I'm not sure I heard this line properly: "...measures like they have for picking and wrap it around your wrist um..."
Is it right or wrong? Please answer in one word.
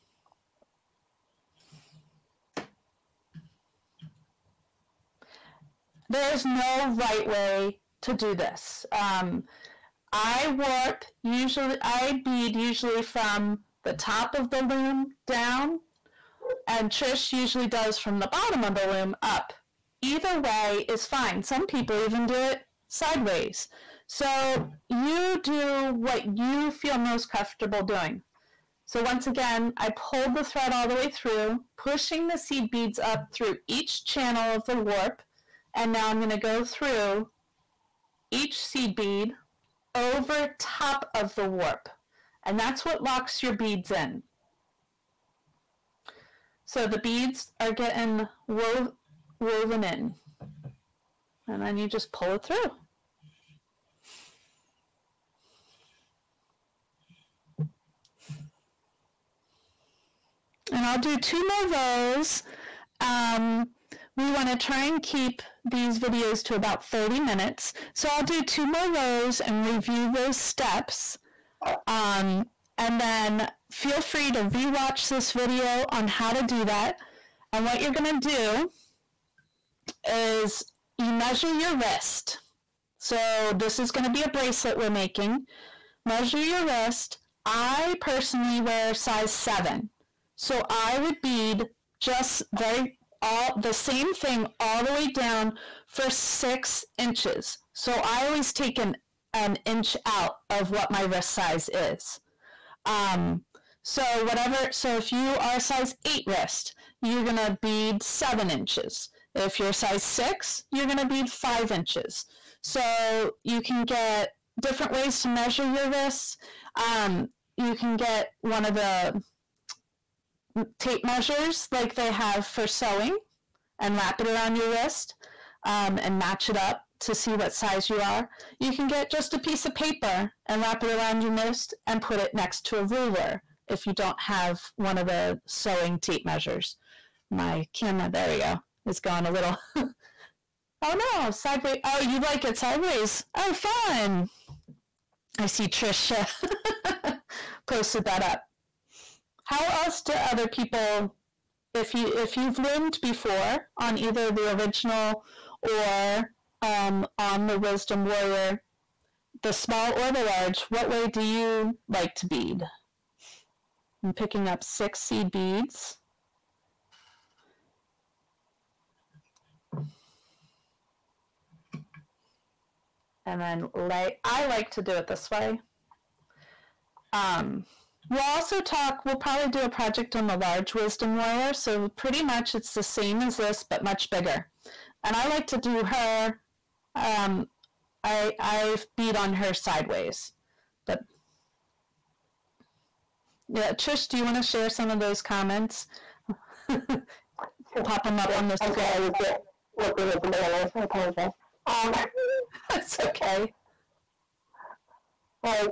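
wrong.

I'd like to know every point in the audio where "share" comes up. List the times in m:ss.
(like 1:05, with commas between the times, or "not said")
3:14.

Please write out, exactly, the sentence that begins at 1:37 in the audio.
So I always take an an inch out of what my wrist size is.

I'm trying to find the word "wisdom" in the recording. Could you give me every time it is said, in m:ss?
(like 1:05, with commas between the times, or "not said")
2:37, 3:00.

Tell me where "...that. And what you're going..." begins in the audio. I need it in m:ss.
1:16.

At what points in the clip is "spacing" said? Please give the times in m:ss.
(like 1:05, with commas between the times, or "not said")
not said.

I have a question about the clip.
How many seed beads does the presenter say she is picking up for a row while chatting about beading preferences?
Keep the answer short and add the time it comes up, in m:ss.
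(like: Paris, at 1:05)
6, at 2:44.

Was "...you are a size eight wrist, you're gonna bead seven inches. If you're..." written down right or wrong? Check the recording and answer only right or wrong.
right.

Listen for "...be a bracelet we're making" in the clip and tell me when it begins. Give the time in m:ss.
1:24.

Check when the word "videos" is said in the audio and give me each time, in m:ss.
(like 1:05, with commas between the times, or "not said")
1:05, 1:15.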